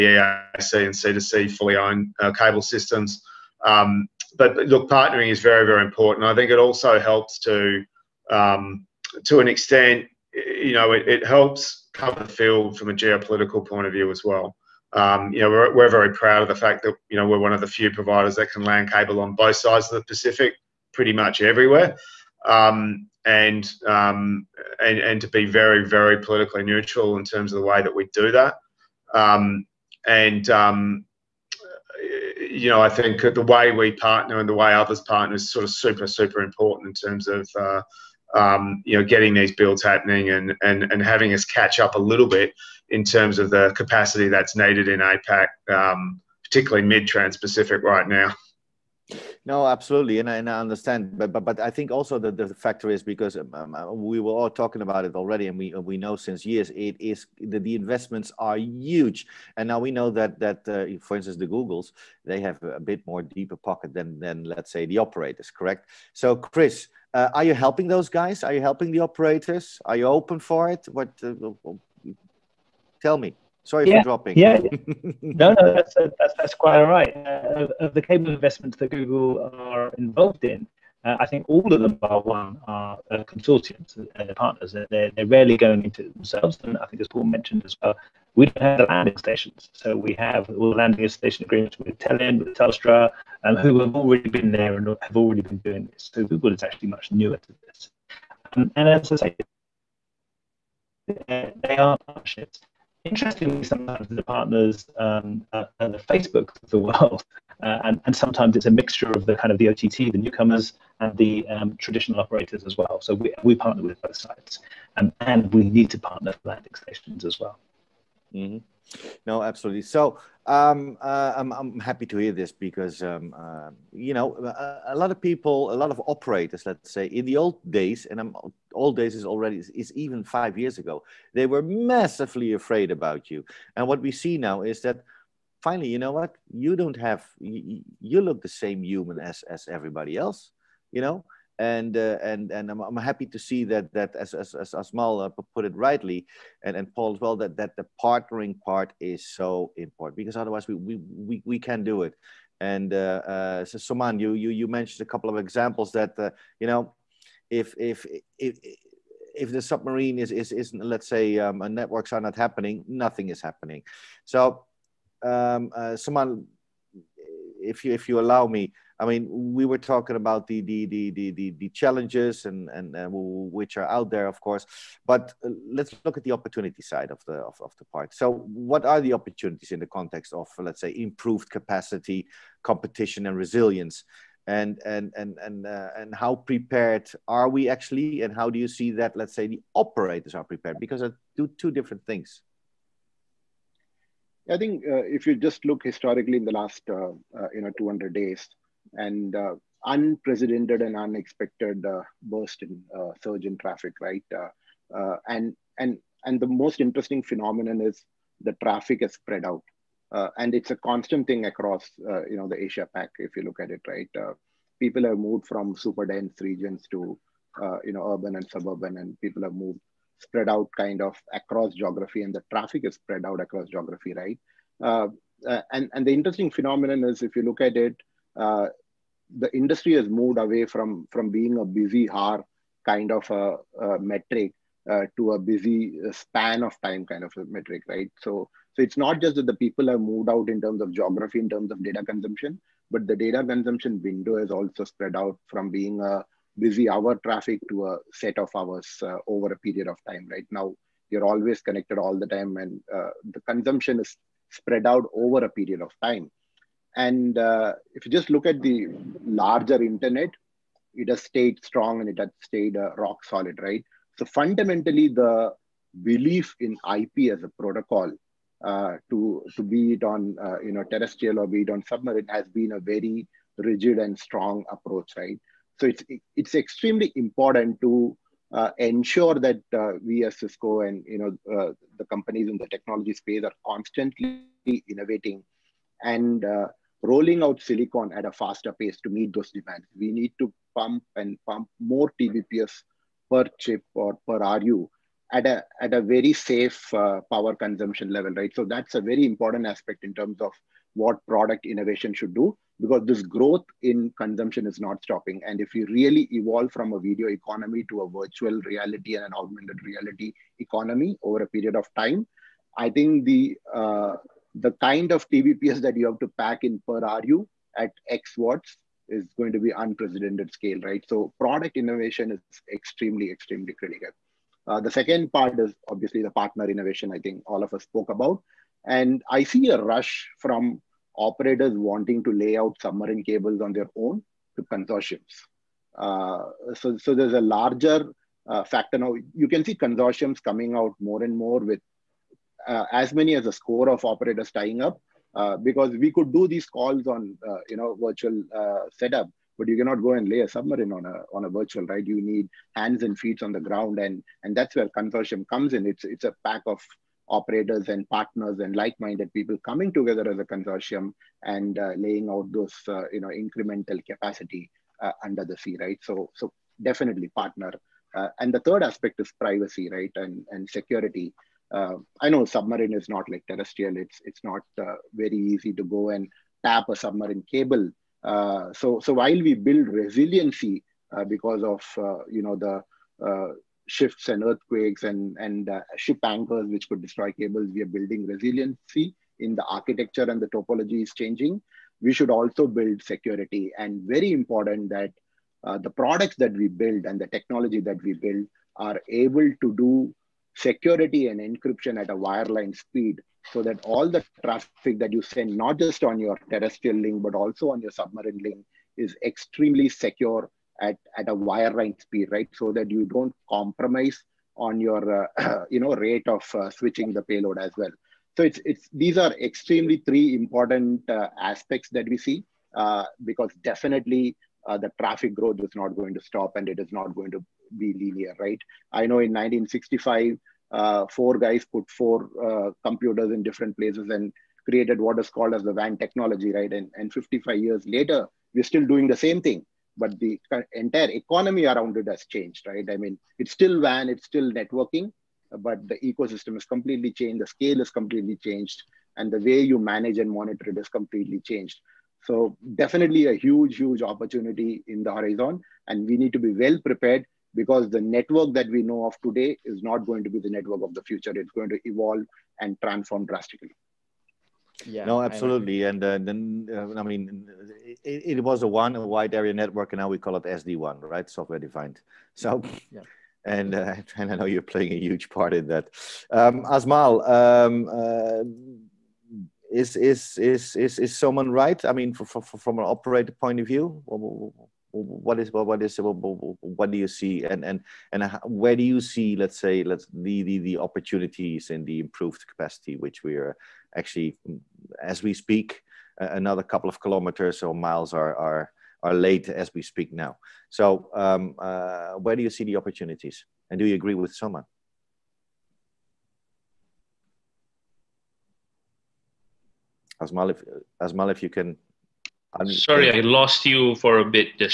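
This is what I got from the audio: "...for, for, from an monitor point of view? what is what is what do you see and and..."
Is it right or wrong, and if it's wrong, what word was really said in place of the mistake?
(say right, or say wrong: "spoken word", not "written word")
wrong: "operator", not "monitor".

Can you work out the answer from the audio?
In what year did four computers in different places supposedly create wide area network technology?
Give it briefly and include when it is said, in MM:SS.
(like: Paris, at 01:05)
1965, at 07:09.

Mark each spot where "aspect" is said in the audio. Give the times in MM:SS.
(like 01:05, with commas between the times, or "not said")
04:59, 06:08, 07:01.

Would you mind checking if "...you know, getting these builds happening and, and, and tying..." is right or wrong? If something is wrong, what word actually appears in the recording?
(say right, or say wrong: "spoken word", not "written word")
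wrong: "having", not "tying".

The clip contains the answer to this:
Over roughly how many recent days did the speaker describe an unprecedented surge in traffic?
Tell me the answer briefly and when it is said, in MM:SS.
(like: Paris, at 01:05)
200 days, at 03:17.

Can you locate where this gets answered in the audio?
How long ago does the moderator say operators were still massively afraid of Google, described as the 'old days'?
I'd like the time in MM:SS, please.
02:10.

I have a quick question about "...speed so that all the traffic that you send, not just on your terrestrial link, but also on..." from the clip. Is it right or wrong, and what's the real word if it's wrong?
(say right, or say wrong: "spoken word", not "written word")
right.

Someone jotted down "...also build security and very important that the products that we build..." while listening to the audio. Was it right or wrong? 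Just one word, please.
right.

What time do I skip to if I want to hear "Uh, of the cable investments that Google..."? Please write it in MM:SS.
01:17.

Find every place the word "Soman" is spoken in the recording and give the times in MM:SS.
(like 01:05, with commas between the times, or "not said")
02:33, 02:45, 08:01, 08:24.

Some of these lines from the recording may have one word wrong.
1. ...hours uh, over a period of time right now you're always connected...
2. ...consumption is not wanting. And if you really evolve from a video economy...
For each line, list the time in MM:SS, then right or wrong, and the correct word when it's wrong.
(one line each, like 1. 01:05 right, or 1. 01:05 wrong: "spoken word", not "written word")
1. 04:08 right
2. 05:04 wrong: "stopping", not "wanting".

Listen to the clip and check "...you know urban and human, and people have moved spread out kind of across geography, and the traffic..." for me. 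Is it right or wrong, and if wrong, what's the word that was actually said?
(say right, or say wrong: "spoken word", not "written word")
wrong: "suburban", not "human".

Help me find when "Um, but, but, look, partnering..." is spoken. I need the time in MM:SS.
00:03.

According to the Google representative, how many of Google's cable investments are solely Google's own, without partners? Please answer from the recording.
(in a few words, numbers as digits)
1.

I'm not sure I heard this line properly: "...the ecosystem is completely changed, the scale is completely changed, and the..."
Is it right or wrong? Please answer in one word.
right.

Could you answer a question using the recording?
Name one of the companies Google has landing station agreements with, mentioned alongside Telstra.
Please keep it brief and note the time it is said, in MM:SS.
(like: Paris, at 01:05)
Telin, at 01:31.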